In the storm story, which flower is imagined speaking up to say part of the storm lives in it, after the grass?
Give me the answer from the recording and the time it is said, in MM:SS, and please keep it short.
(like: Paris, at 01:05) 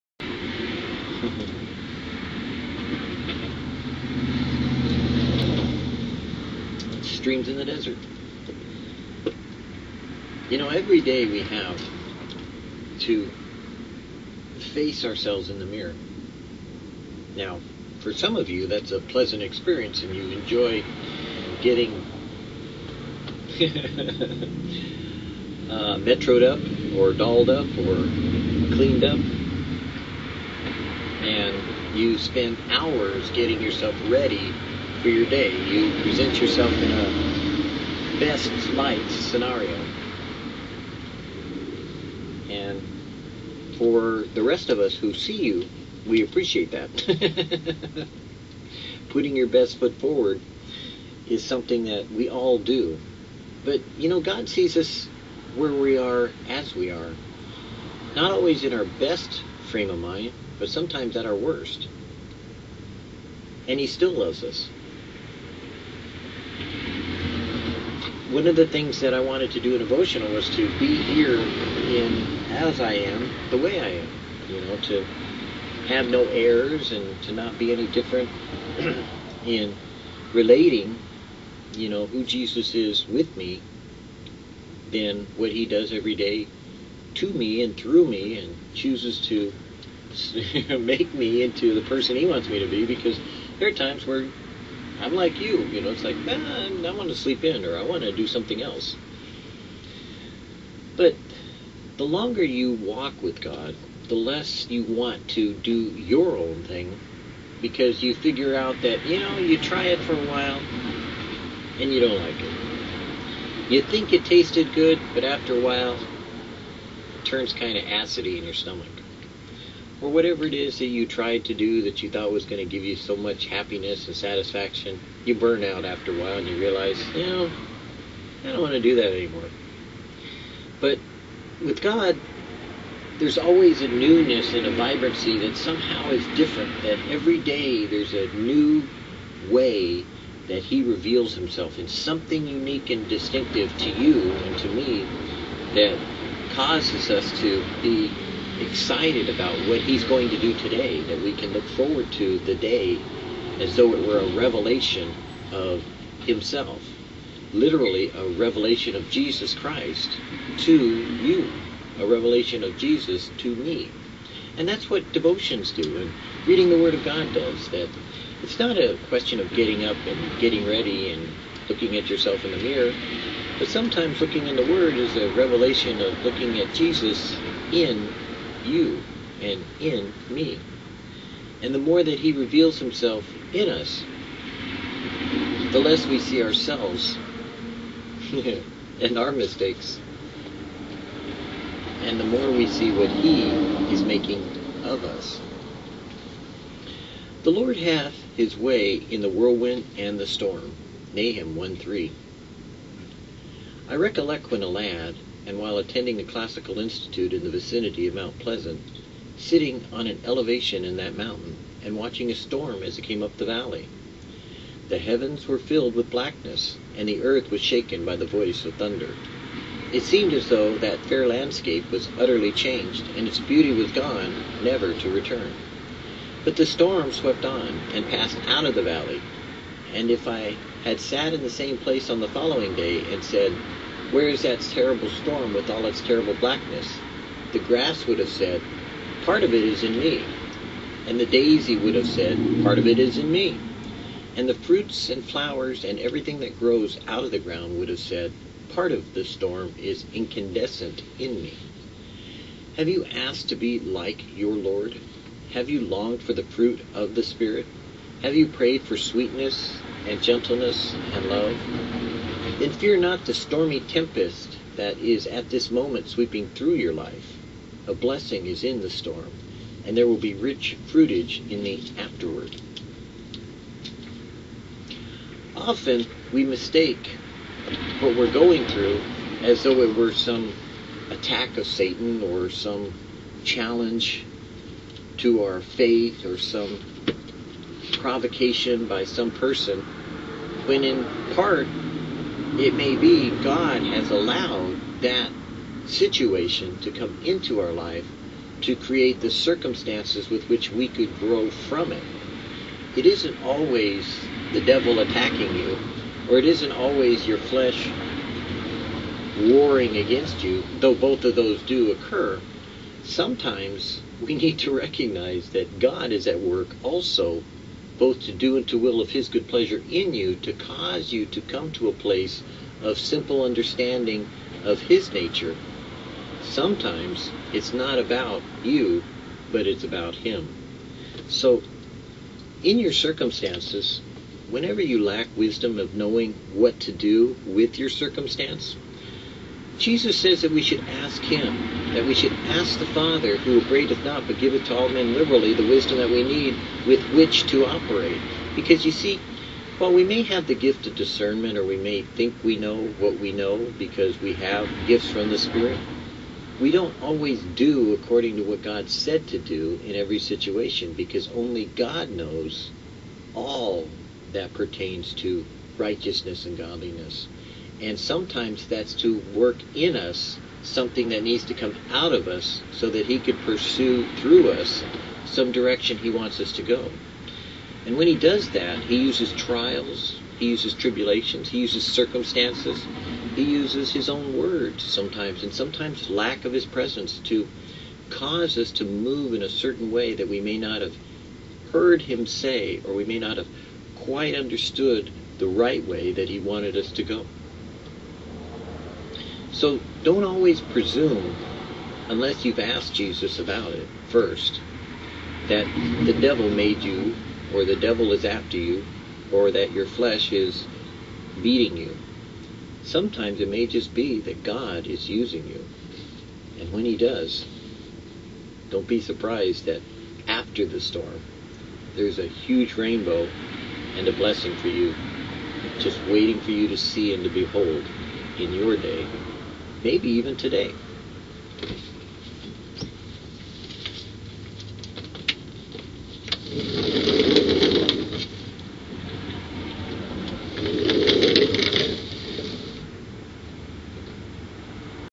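daisy, at 04:01.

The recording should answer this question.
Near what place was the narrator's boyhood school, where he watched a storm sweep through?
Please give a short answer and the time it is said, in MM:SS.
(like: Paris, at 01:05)
Mount Pleasant, at 03:28.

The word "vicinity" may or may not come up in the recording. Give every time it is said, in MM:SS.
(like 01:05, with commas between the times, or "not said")
03:27.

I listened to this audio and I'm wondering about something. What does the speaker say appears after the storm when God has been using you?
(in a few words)
a huge rainbow.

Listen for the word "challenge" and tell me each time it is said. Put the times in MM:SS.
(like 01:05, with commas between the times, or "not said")
04:43.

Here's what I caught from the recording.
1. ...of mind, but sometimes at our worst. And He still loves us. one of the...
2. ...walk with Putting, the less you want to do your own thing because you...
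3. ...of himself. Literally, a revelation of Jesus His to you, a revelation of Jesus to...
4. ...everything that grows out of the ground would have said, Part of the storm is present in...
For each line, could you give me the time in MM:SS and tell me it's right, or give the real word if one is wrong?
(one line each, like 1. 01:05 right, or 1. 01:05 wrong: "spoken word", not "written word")
1. 00:59 right
2. 01:42 wrong: "God", not "Putting"
3. 02:35 wrong: "Christ", not "His"
4. 04:05 wrong: "incandescent", not "present".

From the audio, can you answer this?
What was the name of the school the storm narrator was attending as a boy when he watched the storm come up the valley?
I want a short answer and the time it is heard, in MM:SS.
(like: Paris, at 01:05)
Classical Institute, at 03:26.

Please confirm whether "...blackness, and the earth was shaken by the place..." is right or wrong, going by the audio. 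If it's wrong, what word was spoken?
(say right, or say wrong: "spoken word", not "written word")
wrong: "voice", not "place".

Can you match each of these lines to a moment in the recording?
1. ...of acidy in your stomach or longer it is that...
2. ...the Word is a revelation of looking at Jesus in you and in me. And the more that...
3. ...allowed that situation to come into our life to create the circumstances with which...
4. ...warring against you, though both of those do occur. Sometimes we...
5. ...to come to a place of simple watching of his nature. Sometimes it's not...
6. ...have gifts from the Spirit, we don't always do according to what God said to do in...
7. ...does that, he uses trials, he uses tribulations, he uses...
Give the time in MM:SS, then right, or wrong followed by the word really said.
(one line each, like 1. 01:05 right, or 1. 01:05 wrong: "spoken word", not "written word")
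1. 01:57 wrong: "whatever", not "longer"
2. 02:54 right
3. 04:54 right
4. 05:09 right
5. 05:21 wrong: "understanding", not "watching"
6. 05:54 right
7. 06:18 right.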